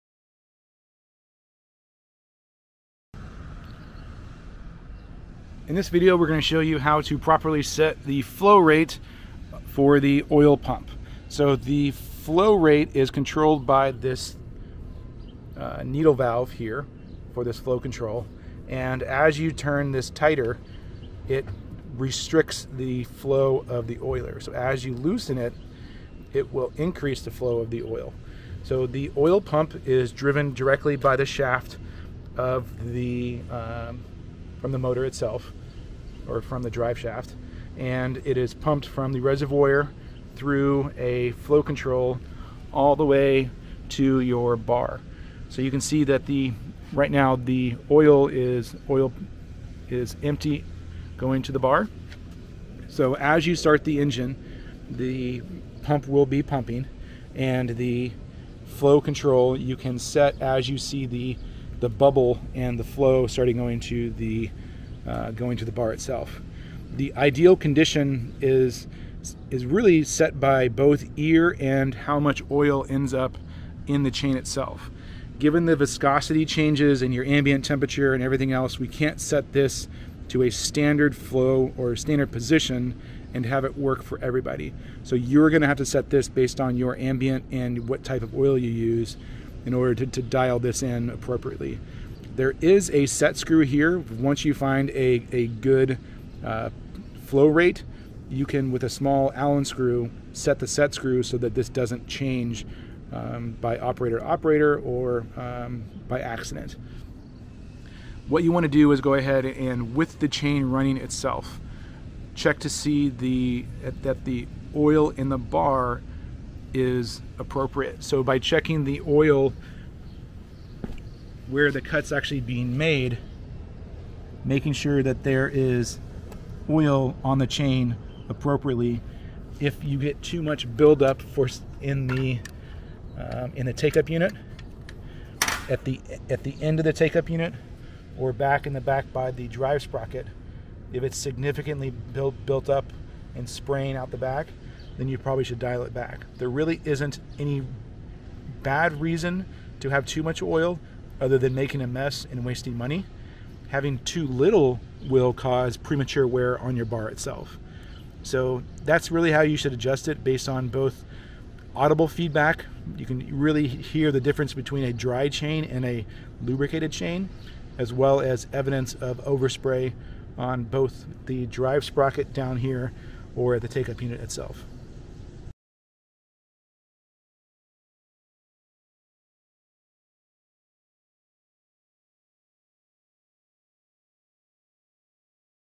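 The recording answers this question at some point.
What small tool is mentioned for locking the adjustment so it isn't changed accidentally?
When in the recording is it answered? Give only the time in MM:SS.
01:39.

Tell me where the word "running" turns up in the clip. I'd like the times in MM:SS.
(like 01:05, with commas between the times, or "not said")
01:50.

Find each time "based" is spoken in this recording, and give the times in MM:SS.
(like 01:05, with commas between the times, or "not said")
01:26, 02:40.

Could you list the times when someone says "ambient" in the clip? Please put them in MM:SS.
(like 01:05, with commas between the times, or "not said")
01:17, 01:26.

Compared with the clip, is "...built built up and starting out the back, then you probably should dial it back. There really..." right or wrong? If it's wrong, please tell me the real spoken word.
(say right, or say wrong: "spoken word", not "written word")
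wrong: "spraying", not "starting".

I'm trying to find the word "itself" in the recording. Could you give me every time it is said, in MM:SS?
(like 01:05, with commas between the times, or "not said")
00:35, 01:05, 01:14, 01:50, 02:37, 02:54.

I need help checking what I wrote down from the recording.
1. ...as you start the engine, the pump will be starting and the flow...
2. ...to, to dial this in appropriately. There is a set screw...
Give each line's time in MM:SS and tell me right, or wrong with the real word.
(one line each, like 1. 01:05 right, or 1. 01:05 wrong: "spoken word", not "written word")
1. 00:53 wrong: "pumping", not "starting"
2. 01:29 right.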